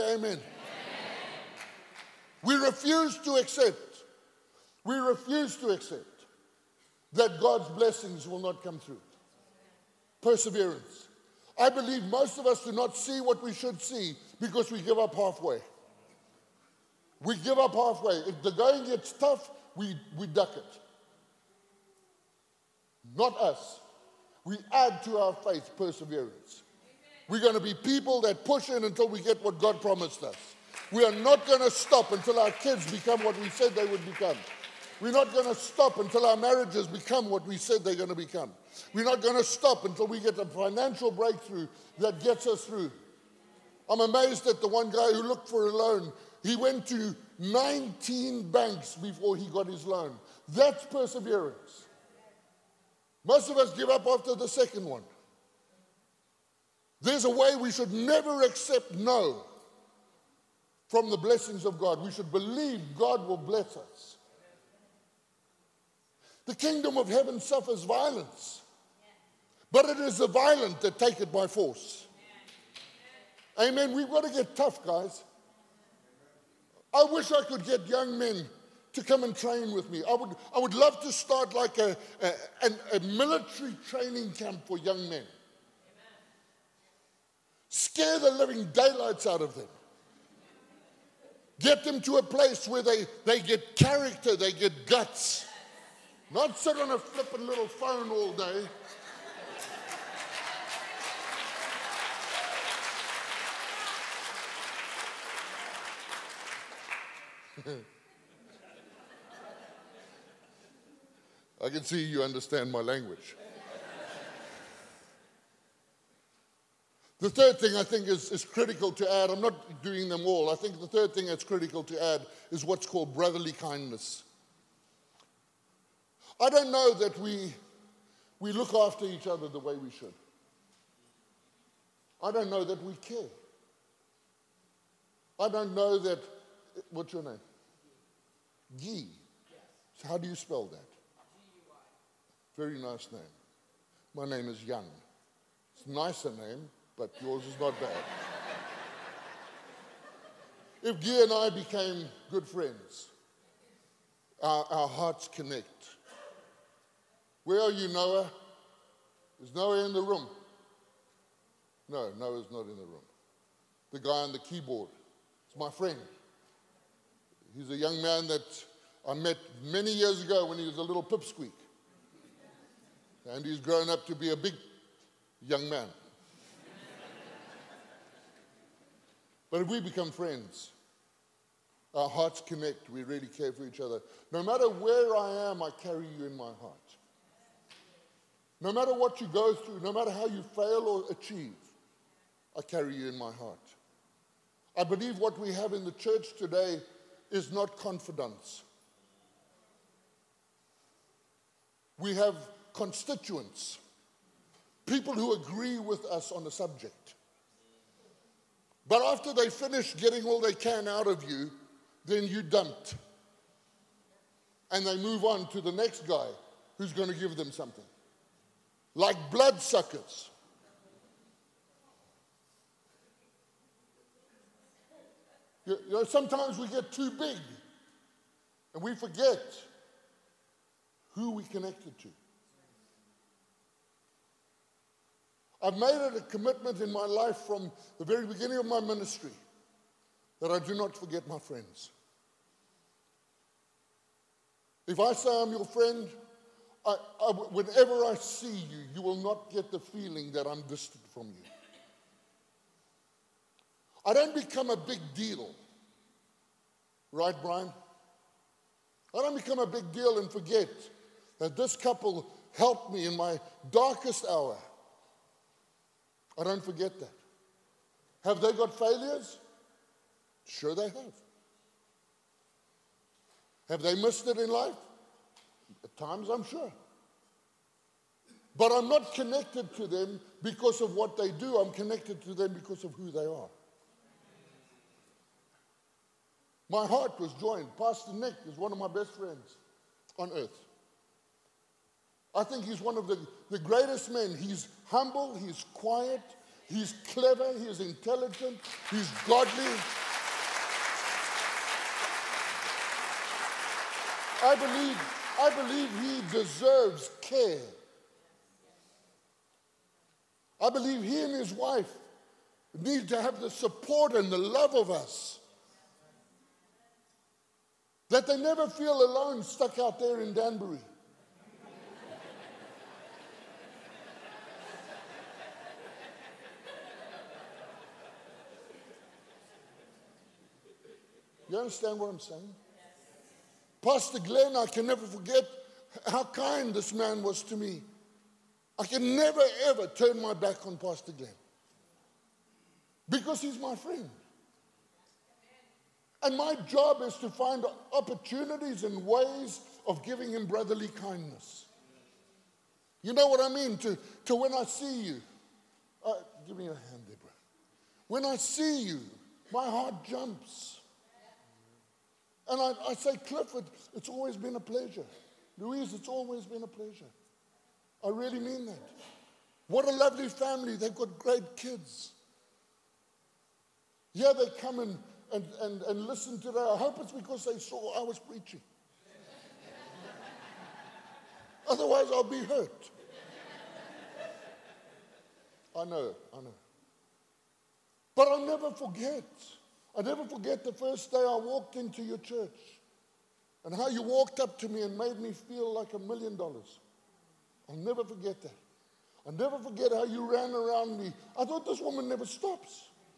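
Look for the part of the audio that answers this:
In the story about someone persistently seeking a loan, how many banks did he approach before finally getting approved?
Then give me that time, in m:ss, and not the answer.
0:47.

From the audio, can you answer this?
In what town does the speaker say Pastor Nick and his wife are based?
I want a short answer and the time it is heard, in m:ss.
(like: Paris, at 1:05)
Danbury, at 5:20.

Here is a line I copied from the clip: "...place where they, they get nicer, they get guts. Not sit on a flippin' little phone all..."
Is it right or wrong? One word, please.
wrong.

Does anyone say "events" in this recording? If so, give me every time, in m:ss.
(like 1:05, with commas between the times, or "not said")
not said.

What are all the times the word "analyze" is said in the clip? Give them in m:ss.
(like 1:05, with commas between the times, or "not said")
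not said.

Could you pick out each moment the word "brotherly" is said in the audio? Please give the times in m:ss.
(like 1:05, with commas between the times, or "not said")
2:03, 5:50.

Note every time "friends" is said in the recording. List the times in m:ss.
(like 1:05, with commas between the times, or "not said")
2:32, 2:45, 3:00, 4:01, 4:05, 4:49, 5:43.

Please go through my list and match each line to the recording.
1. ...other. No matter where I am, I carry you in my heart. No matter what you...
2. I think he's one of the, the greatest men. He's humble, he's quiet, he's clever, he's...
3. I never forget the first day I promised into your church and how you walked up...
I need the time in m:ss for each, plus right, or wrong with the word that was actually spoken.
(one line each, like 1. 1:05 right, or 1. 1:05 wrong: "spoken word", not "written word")
1. 3:03 right
2. 4:52 right
3. 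6:29 wrong: "walked", not "promised".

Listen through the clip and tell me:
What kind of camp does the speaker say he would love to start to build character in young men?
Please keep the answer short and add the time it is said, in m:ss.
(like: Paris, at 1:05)
military training camp, at 1:22.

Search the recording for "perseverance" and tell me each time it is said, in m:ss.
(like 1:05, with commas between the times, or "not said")
0:10, 0:25, 0:50.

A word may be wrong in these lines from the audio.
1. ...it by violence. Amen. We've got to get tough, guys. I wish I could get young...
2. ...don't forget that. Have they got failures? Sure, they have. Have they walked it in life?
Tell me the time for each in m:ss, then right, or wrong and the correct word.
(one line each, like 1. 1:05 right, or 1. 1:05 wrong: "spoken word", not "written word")
1. 1:11 wrong: "force", not "violence"
2. 4:26 wrong: "missed", not "walked".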